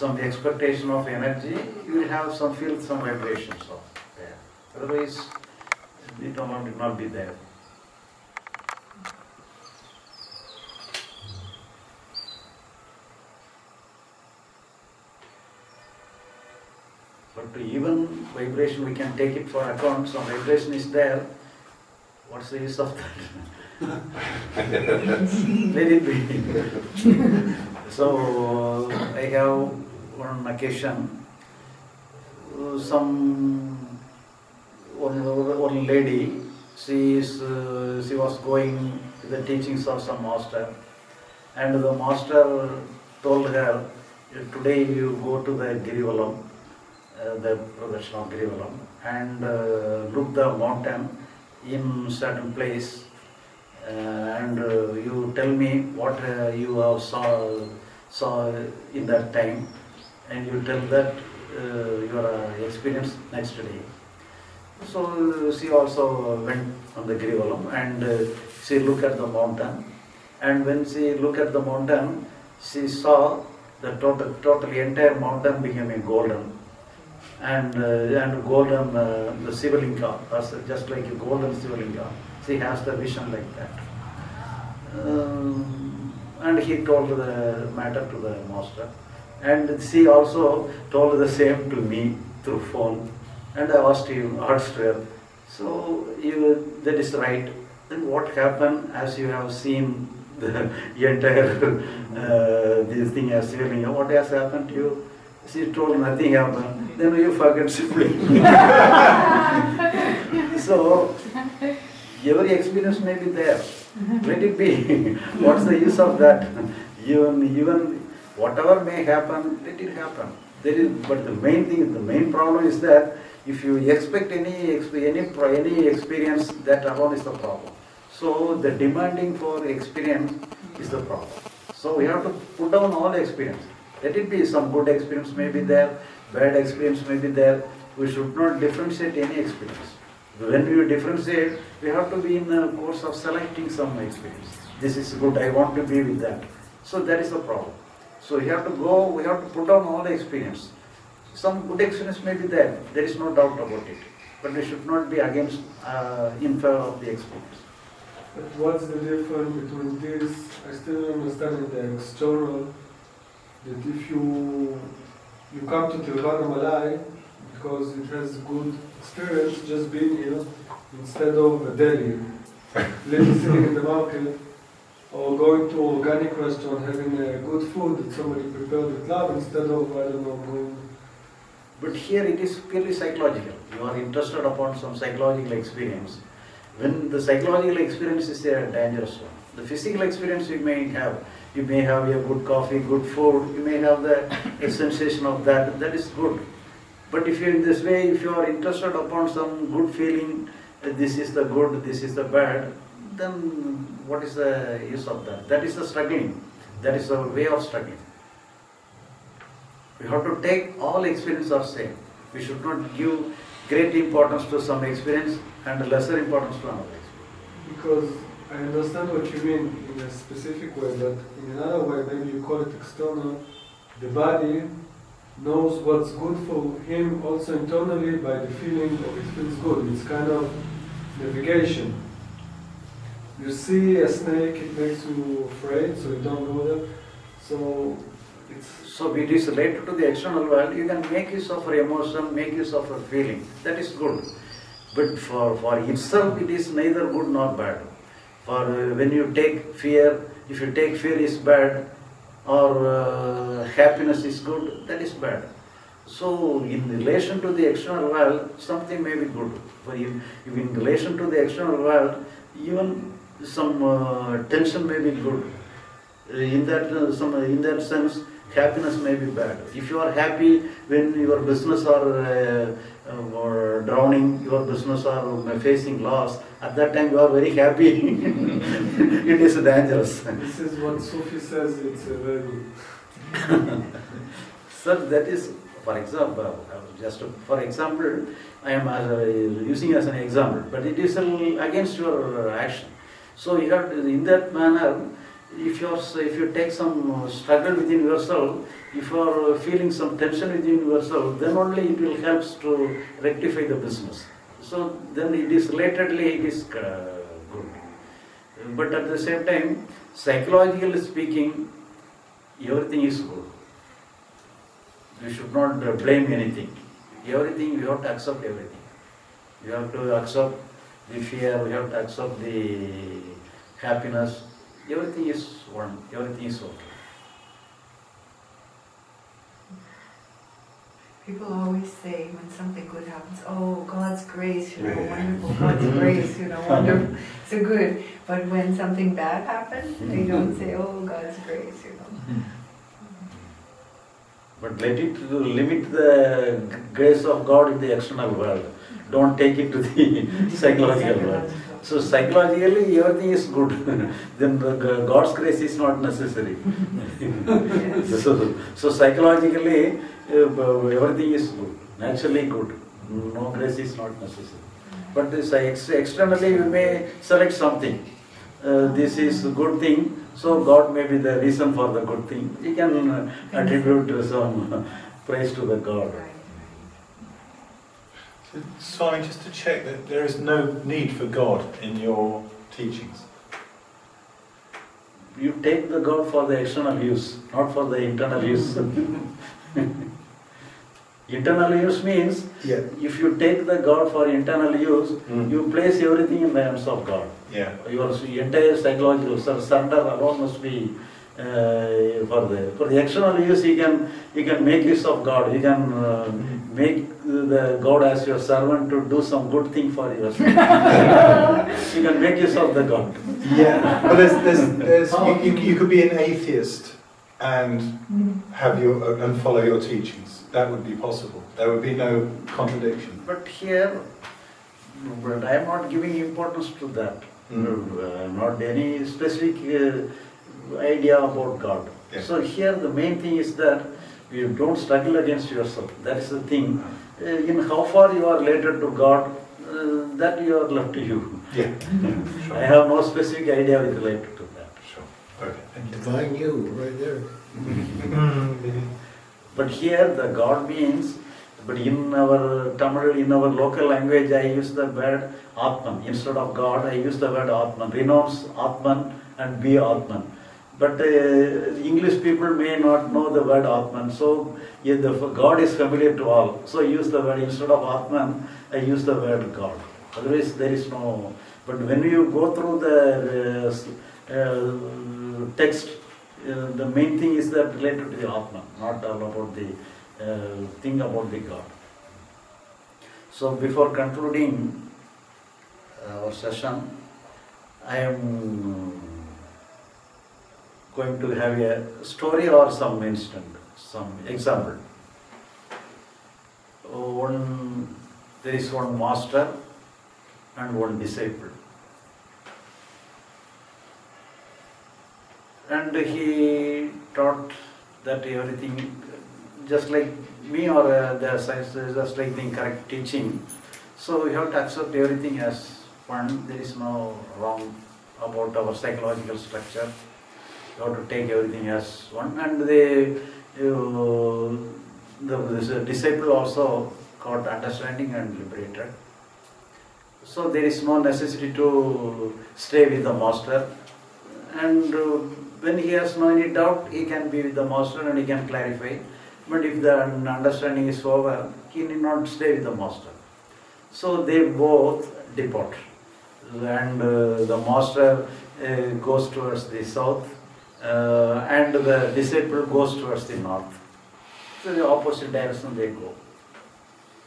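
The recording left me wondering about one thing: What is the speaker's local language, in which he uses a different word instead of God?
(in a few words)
Tamil.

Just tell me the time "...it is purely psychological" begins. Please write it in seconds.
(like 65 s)
182 s.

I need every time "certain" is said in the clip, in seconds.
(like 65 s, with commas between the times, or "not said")
52 s.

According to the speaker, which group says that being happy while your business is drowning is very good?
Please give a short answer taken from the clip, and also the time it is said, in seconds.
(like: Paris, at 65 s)
Sufi, at 281 s.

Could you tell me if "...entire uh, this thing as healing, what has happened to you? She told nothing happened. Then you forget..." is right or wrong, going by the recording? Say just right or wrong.
right.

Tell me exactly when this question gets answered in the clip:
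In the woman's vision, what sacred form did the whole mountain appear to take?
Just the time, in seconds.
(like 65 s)
81 s.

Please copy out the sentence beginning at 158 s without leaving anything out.
But what's the difference between this?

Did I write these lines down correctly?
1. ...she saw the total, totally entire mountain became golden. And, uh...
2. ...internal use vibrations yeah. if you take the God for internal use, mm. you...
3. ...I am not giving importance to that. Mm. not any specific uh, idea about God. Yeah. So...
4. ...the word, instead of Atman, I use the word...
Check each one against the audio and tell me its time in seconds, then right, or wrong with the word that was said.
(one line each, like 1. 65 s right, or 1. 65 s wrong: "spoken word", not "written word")
1. 72 s right
2. 391 s wrong: "means", not "vibrations"
3. 425 s right
4. 467 s right.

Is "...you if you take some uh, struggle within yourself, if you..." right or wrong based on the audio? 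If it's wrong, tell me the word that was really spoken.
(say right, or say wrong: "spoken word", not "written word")
right.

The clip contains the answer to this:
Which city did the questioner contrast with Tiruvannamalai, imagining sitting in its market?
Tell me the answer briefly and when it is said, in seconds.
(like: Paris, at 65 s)
Delhi, at 171 s.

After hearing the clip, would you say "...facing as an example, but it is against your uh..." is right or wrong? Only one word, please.
wrong.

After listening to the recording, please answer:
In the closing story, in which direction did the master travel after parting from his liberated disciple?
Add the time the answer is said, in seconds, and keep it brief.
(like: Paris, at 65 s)
south, at 549 s.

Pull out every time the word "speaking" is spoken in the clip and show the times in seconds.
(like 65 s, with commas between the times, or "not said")
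310 s.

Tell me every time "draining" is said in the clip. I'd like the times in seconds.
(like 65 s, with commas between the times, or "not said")
not said.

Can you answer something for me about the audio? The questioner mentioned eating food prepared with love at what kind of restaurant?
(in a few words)
organic restaurant.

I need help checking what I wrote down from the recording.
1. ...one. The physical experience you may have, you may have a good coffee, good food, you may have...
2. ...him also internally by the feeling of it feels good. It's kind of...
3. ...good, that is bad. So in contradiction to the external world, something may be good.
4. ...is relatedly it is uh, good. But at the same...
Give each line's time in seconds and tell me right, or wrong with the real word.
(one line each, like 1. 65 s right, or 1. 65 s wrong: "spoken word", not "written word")
1. 189 s right
2. 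226 s right
3. 254 s wrong: "relation", not "contradiction"
4. 305 s right.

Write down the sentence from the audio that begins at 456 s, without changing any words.
Instead of God, I use the word Atman.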